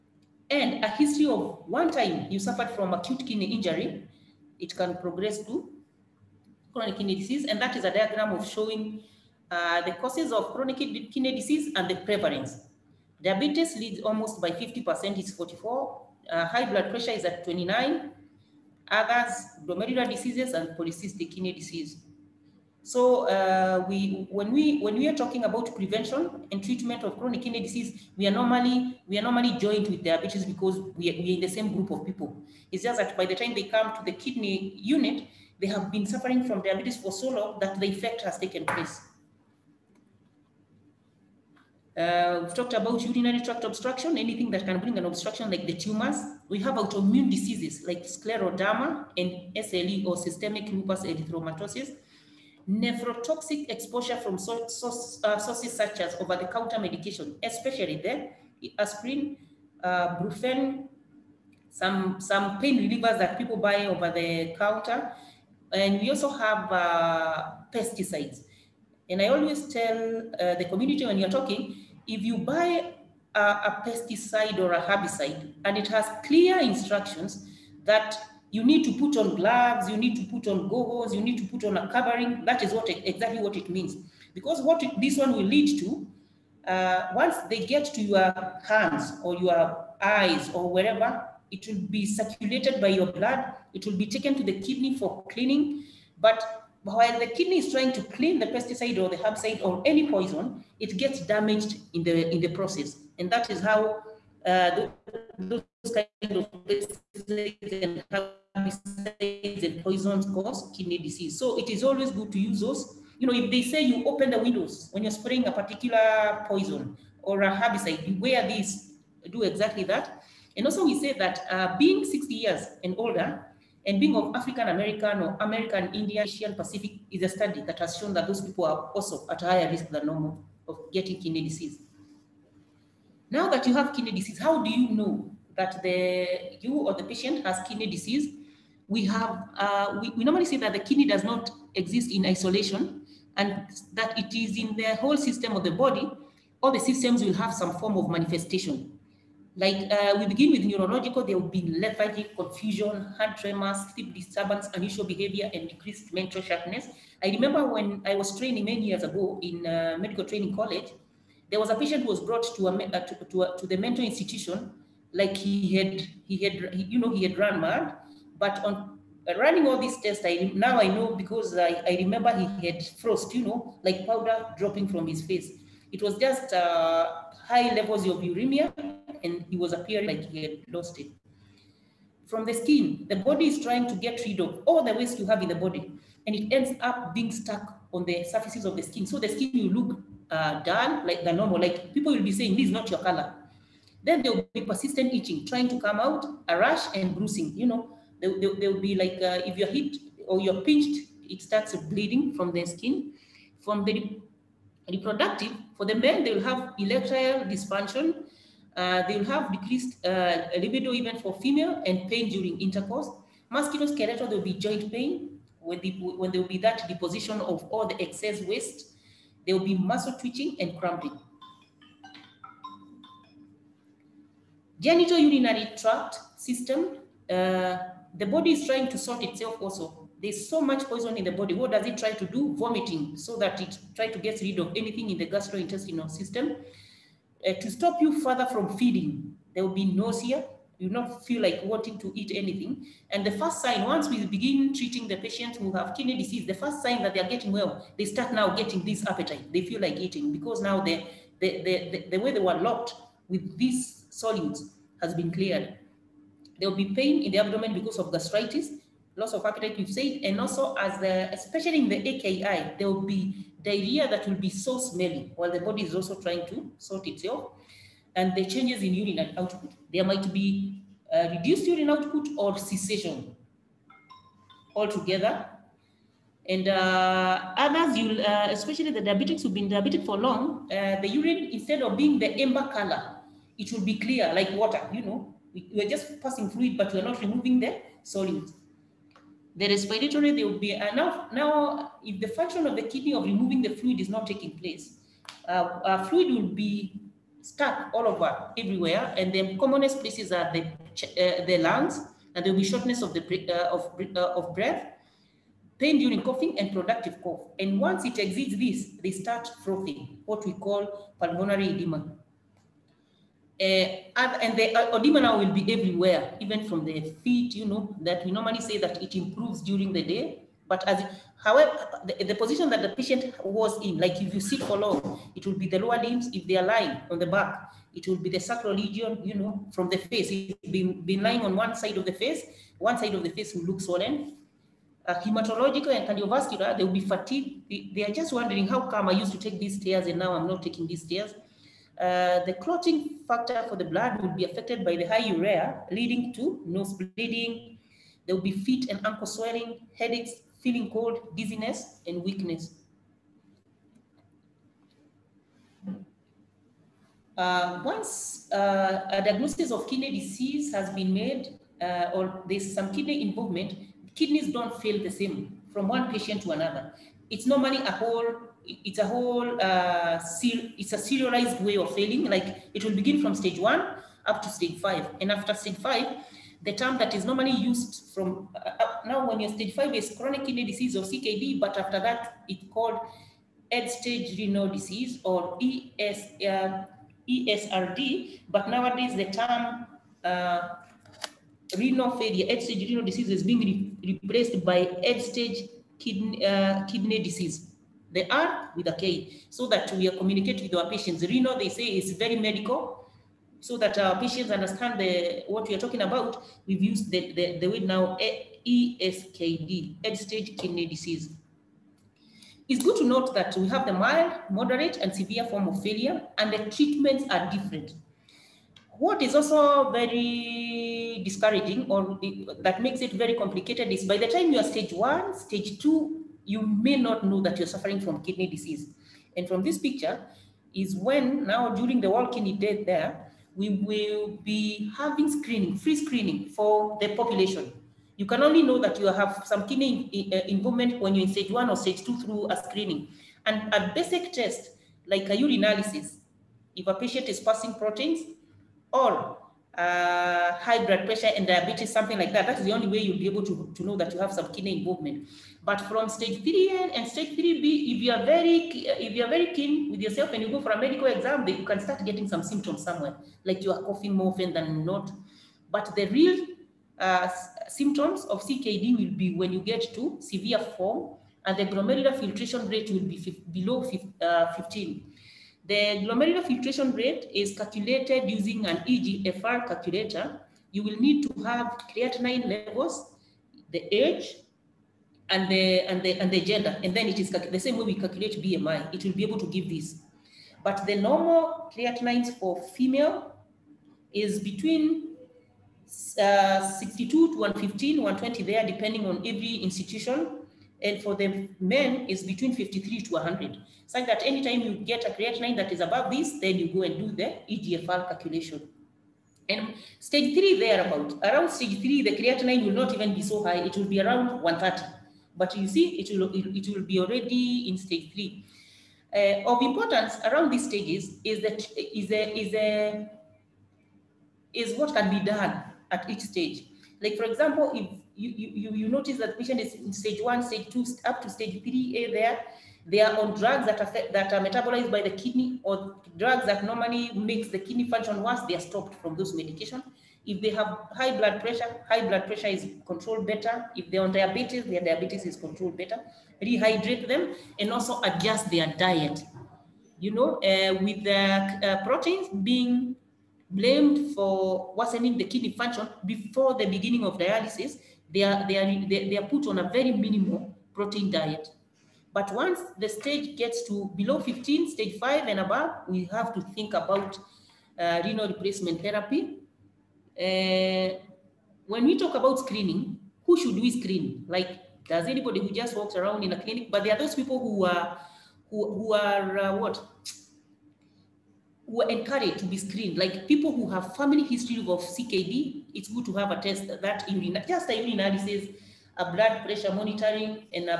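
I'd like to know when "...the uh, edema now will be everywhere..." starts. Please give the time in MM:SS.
05:14.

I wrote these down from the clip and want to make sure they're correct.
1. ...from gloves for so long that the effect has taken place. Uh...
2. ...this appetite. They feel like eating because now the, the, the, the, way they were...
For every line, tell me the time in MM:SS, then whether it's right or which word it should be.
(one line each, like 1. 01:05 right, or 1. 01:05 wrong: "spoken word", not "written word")
1. 00:36 wrong: "diabetes", not "gloves"
2. 04:08 right.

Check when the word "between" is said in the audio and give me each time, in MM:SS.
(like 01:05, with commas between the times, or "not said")
08:14, 08:22.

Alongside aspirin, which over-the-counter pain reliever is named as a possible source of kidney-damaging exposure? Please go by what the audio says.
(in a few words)
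Brufen.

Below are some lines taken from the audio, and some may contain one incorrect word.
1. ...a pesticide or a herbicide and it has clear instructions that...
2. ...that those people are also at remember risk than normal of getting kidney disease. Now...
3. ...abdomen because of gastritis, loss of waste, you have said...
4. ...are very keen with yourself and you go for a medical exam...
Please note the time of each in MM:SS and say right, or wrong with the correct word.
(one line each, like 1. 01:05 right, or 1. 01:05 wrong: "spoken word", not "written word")
1. 01:13 right
2. 02:08 wrong: "higher", not "remember"
3. 04:17 wrong: "appetite", not "waste"
4. 07:39 right.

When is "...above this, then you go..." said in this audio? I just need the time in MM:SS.
08:25.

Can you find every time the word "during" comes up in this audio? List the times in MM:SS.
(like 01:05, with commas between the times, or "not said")
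03:32, 05:05, 05:19, 07:11.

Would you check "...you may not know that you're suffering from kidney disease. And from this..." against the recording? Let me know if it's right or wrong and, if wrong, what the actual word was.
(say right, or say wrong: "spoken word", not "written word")
right.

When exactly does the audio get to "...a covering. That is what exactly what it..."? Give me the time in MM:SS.
01:21.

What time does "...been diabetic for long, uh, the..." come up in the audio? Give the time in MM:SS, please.
04:39.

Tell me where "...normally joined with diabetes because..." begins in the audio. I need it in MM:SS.
00:29.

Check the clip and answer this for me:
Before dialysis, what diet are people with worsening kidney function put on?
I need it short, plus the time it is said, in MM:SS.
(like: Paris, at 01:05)
minimal protein diet, at 09:19.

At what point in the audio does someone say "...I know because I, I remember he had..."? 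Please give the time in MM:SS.
02:50.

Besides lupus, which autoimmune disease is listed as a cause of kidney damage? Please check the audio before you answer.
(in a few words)
scleroderma.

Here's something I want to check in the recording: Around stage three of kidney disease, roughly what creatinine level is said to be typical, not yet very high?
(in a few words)
130.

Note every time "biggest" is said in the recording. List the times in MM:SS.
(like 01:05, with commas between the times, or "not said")
not said.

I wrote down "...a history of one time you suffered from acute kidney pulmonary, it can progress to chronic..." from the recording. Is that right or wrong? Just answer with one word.
wrong.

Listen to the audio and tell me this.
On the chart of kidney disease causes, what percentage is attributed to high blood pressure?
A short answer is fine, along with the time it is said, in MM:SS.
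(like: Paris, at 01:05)
29, at 00:17.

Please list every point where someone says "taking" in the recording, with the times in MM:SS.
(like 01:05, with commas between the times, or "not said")
04:54, 05:40.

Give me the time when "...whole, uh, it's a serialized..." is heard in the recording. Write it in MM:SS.
06:09.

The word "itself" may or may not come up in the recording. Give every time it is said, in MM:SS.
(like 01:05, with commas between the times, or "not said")
03:49, 04:27.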